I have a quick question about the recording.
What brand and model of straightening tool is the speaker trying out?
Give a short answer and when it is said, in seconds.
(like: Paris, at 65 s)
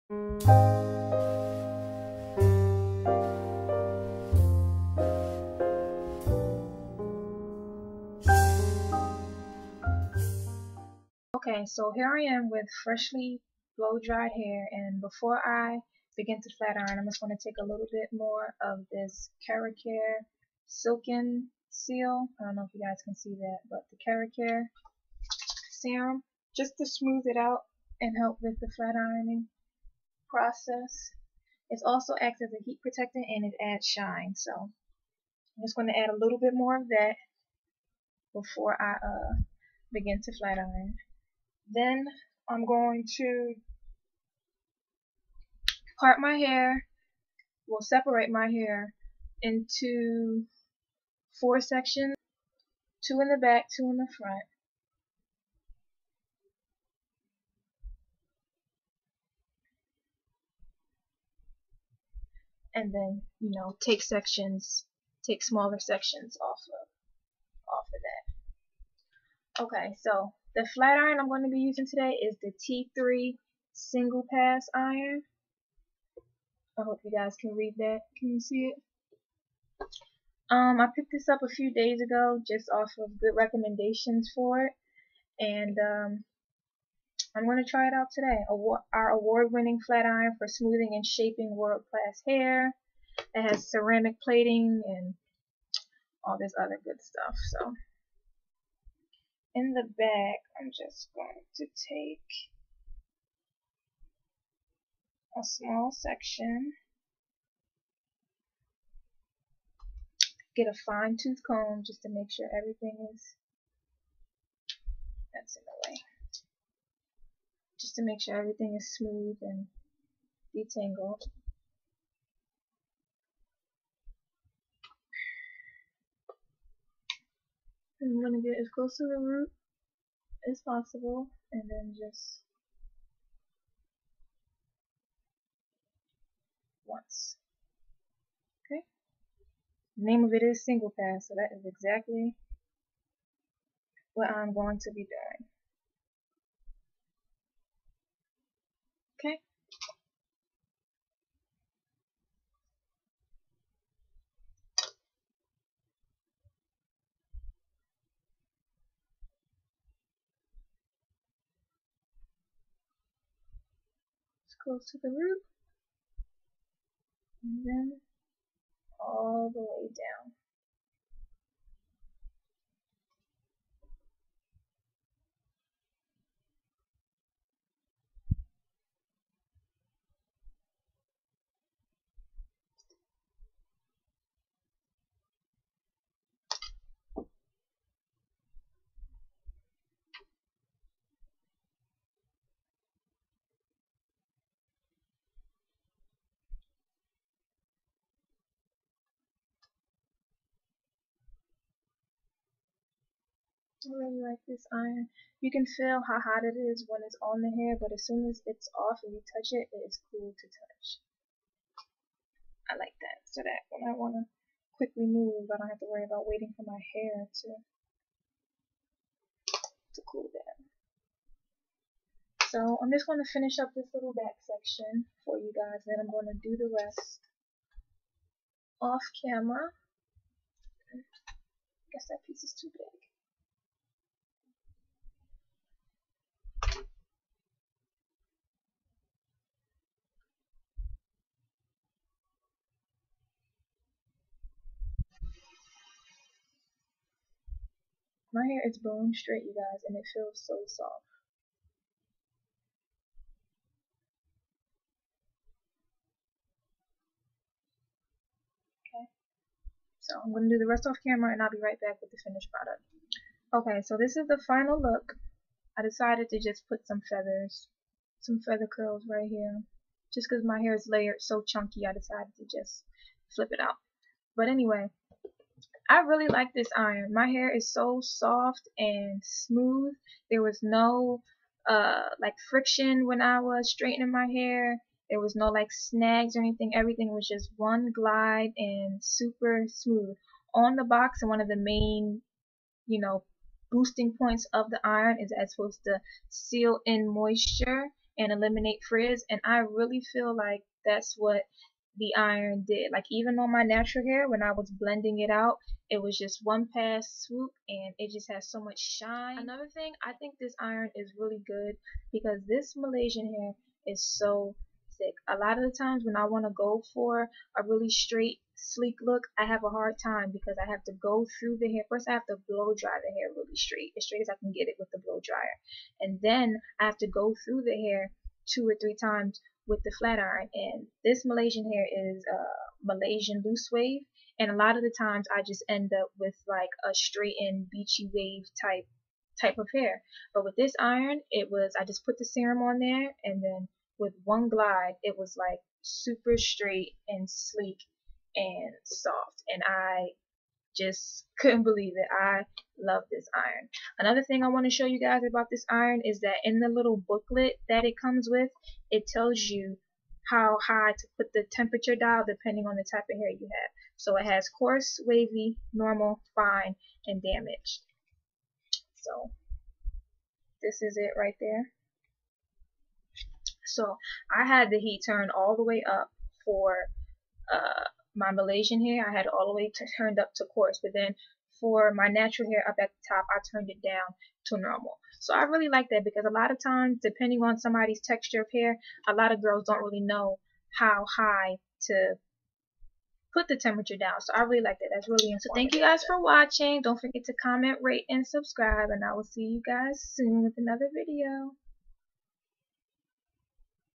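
T3 single pass, at 72 s.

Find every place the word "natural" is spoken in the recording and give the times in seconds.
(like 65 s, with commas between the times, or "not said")
303 s, 382 s.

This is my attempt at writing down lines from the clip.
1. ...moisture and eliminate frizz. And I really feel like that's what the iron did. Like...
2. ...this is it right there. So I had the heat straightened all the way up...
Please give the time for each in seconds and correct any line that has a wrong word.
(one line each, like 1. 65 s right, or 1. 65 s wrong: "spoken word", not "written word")
1. 297 s right
2. 370 s wrong: "turned", not "straightened".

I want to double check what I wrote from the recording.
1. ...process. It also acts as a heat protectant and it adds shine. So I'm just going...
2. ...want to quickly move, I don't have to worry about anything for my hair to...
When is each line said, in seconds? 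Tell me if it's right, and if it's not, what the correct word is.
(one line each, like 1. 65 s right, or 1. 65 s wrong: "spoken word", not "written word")
1. 30 s right
2. 213 s wrong: "waiting", not "anything".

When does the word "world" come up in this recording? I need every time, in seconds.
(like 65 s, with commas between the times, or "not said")
91 s.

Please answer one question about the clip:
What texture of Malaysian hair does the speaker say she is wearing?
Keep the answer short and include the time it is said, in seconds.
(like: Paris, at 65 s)
loose wave, at 333 s.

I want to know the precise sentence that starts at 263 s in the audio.
Okay, so this is the final look.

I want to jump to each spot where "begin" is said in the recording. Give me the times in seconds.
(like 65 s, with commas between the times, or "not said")
16 s, 39 s.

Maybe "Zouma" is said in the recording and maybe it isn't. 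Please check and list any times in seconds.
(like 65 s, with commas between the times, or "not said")
not said.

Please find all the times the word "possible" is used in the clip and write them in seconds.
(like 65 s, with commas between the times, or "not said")
130 s.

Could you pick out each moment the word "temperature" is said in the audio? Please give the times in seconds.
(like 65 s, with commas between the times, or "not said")
361 s, 393 s.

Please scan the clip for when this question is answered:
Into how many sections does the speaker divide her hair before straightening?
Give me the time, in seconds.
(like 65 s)
51 s.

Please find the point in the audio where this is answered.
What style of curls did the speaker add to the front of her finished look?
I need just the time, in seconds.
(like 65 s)
268 s.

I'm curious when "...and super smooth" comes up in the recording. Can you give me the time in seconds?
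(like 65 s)
288 s.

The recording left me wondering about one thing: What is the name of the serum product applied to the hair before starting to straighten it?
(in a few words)
KeraCare Silken Seal.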